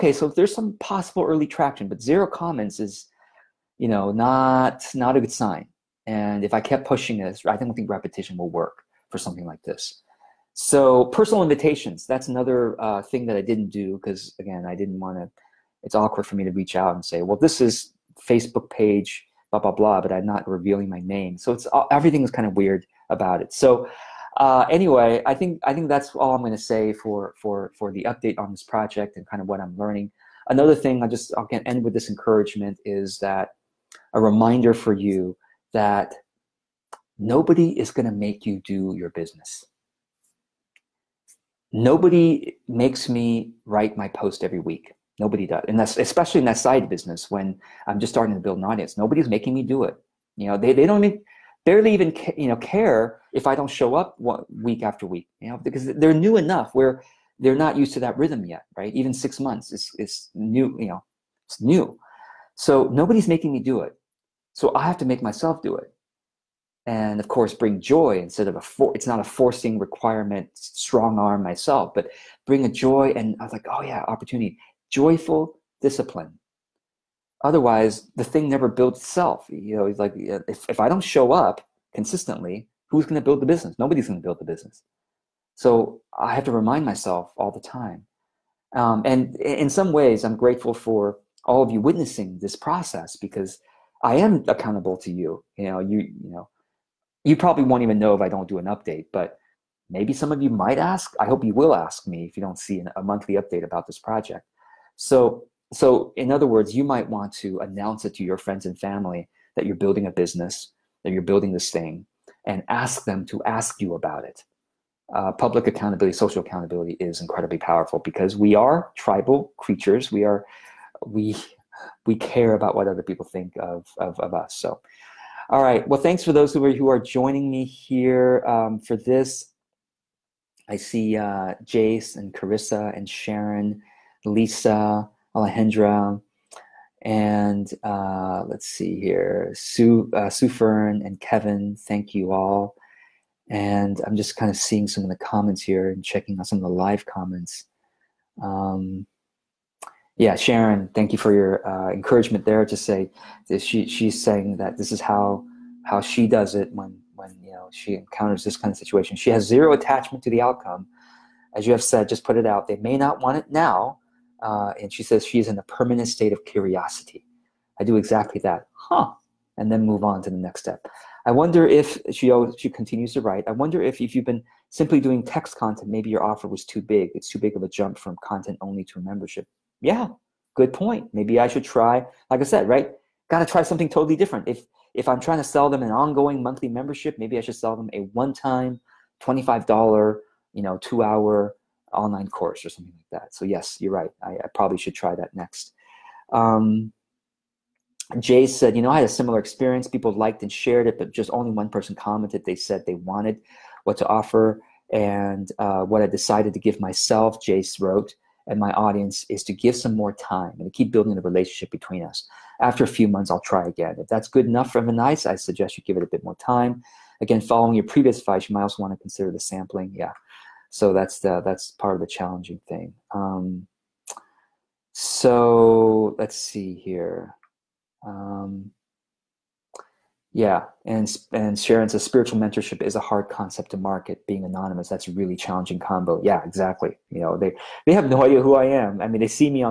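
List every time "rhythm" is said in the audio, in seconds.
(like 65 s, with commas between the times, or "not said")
58 s.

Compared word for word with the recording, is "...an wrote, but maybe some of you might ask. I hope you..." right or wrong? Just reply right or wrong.
wrong.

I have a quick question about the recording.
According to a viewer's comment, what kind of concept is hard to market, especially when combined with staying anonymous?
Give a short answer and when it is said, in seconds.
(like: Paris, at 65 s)
spiritual mentorship, at 232 s.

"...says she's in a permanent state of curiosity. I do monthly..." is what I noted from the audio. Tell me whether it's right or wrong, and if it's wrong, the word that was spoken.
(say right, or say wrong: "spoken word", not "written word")
wrong: "exactly", not "monthly".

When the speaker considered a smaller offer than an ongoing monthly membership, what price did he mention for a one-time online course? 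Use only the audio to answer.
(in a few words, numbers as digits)
$25.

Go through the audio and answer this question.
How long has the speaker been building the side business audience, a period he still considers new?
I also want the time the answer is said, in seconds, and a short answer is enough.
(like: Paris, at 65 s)
six months, at 59 s.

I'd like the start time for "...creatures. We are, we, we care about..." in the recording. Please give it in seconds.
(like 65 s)
119 s.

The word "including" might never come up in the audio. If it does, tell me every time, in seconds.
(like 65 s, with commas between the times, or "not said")
not said.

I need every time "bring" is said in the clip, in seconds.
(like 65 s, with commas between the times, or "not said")
67 s, 72 s.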